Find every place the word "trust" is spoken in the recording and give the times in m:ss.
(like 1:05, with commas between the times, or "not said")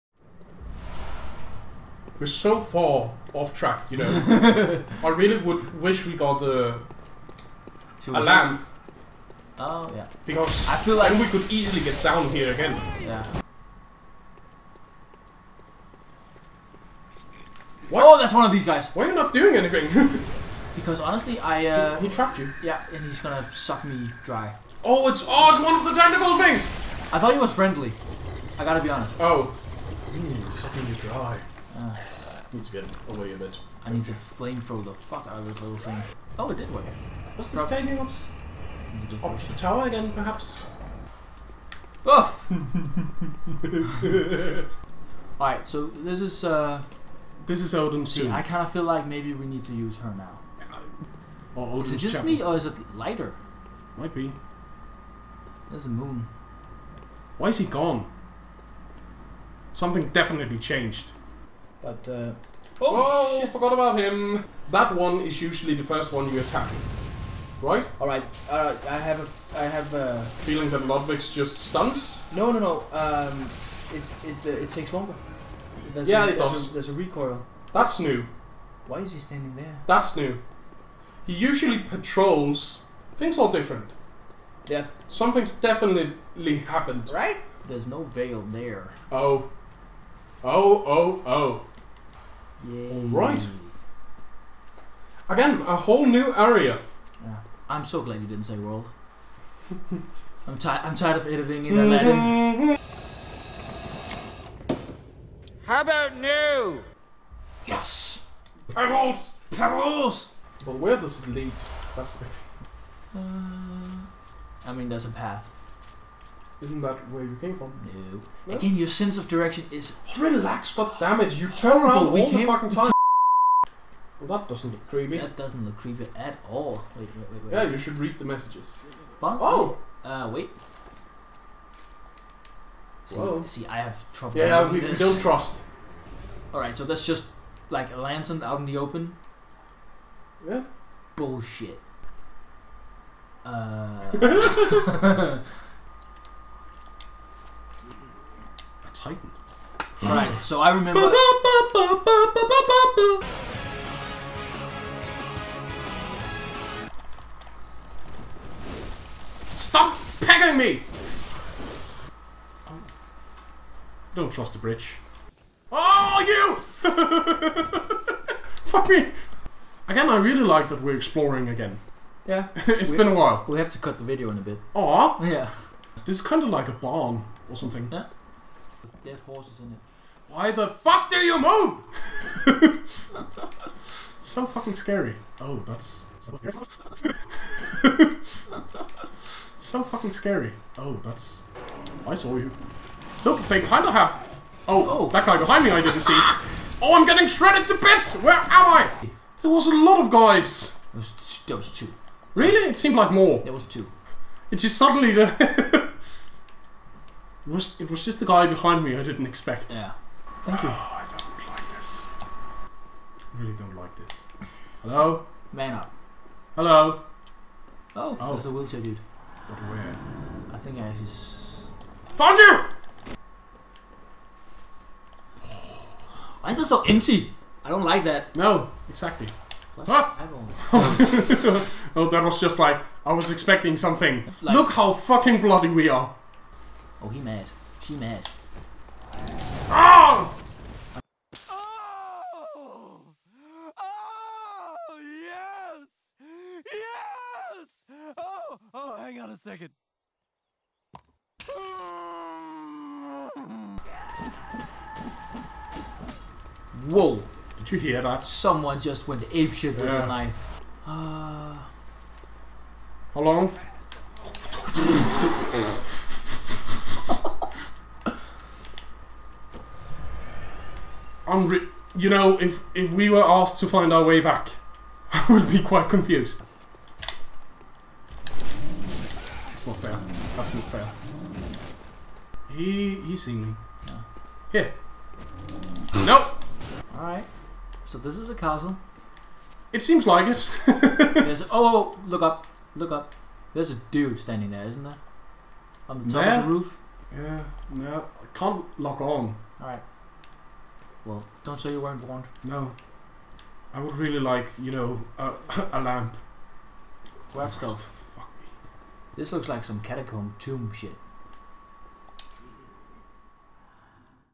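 2:15, 2:44.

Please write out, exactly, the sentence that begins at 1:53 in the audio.
Uh, I mean, there's a path.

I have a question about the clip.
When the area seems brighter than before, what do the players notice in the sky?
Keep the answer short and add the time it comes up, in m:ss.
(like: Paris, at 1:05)
A moon, at 0:55.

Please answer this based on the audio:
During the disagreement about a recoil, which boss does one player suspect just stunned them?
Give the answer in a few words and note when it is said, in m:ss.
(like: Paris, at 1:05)
Ludwig, at 1:10.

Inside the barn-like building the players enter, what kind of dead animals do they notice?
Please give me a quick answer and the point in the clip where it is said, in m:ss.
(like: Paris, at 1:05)
Horses, at 2:59.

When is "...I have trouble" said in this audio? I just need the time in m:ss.
2:13.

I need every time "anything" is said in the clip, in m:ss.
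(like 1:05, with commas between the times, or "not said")
0:19.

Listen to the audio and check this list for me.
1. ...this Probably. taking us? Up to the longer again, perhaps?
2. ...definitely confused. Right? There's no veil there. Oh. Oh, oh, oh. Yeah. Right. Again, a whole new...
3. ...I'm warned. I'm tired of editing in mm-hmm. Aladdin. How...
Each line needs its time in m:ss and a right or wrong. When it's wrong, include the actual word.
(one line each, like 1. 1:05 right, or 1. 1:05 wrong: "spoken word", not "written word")
1. 0:37 wrong: "tower", not "longer"
2. 1:25 wrong: "happened", not "confused"
3. 1:40 wrong: "tired", not "warned".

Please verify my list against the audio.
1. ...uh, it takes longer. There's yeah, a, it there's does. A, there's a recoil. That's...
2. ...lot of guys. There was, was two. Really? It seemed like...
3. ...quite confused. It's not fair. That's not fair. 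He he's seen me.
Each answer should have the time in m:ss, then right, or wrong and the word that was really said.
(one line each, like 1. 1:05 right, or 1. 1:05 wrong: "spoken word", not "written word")
1. 1:14 right
2. 3:19 right
3. 4:35 right.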